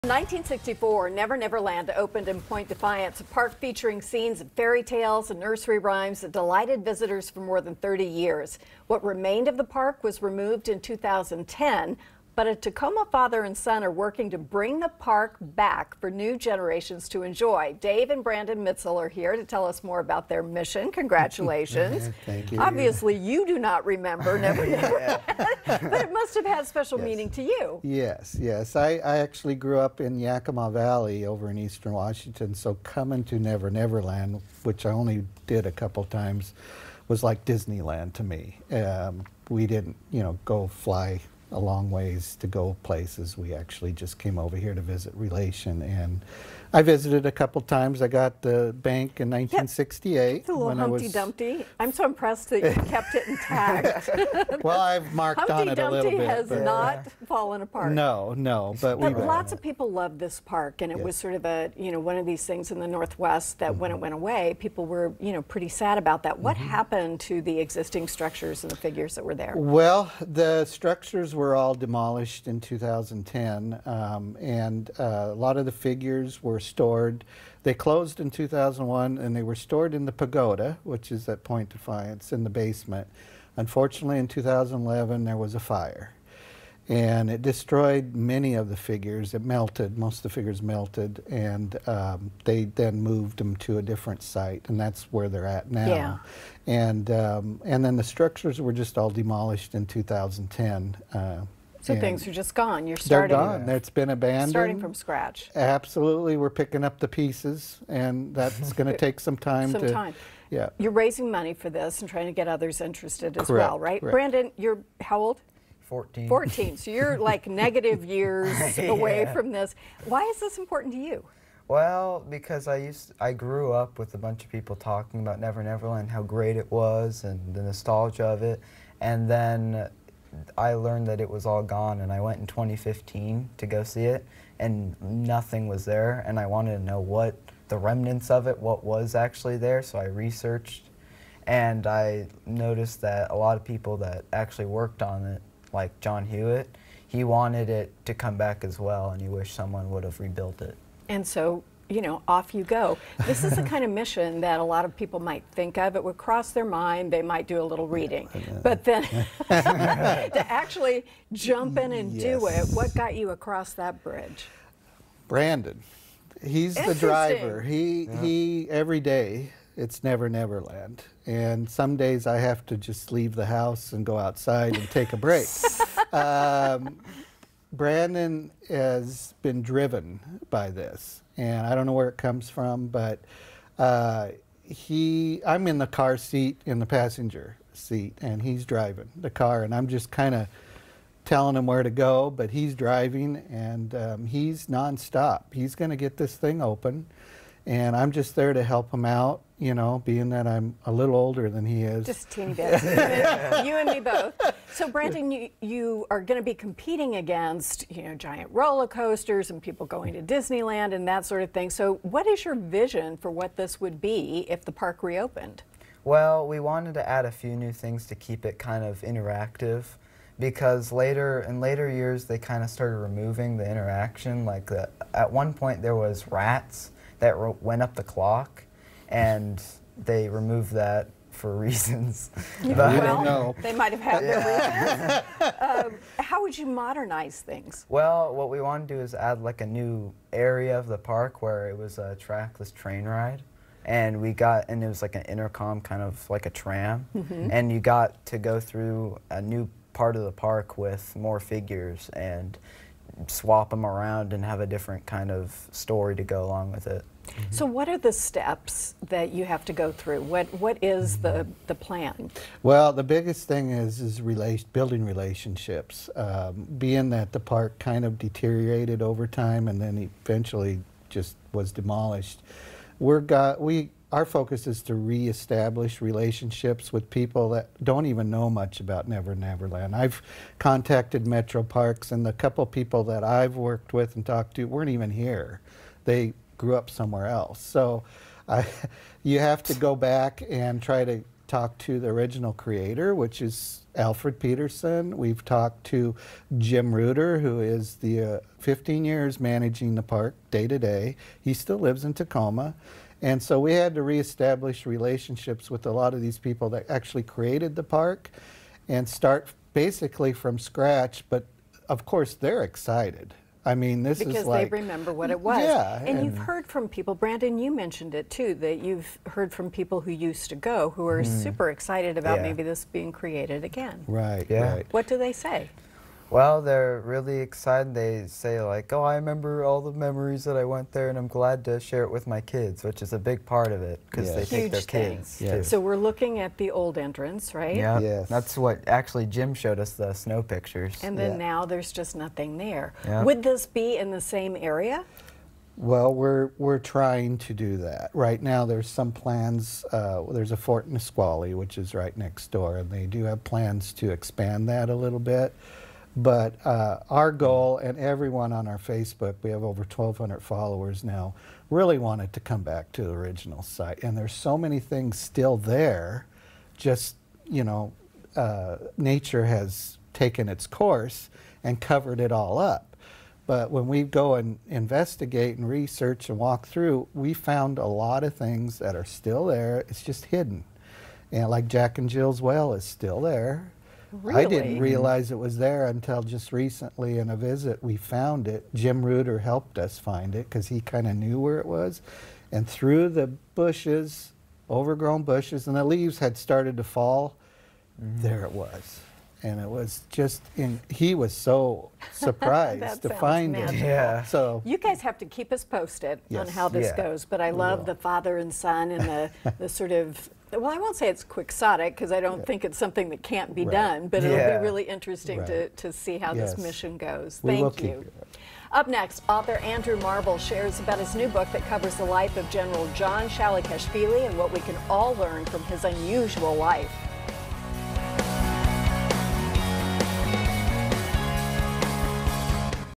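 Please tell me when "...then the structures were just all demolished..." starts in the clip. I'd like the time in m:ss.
1:37.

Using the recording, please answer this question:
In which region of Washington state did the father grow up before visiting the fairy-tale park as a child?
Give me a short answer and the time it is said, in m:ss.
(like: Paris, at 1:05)
Yakima Valley, at 0:30.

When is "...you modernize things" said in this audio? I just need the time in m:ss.
3:56.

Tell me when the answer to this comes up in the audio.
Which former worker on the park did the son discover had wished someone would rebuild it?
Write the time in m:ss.
2:25.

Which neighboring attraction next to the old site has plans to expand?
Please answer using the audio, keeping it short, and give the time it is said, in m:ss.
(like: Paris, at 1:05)
Fort Nisqually, at 5:50.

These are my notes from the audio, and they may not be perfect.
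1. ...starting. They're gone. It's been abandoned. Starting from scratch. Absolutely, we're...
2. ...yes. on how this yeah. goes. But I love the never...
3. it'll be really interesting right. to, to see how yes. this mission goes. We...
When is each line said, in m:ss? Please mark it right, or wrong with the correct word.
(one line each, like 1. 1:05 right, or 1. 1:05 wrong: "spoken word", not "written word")
1. 1:42 right
2. 6:46 wrong: "father", not "never"
3. 6:54 right.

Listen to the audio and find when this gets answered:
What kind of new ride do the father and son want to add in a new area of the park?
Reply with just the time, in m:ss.
4:02.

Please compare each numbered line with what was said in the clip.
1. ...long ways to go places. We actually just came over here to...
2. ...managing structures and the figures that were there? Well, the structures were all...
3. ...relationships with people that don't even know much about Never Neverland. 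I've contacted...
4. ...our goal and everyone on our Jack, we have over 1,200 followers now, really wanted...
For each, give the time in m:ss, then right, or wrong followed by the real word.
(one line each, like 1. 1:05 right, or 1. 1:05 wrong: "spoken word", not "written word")
1. 0:41 right
2. 1:07 wrong: "existing", not "managing"
3. 4:36 right
4. 5:57 wrong: "Facebook", not "Jack".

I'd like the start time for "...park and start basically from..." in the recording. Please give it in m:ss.
5:07.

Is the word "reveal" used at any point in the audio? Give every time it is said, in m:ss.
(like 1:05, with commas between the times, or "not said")
not said.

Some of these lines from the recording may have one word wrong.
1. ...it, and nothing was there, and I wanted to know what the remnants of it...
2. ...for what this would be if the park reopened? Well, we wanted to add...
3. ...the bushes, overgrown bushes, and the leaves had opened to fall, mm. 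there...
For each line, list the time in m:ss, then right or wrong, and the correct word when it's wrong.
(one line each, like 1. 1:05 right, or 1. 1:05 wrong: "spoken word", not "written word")
1. 2:14 right
2. 3:33 right
3. 6:33 wrong: "started", not "opened".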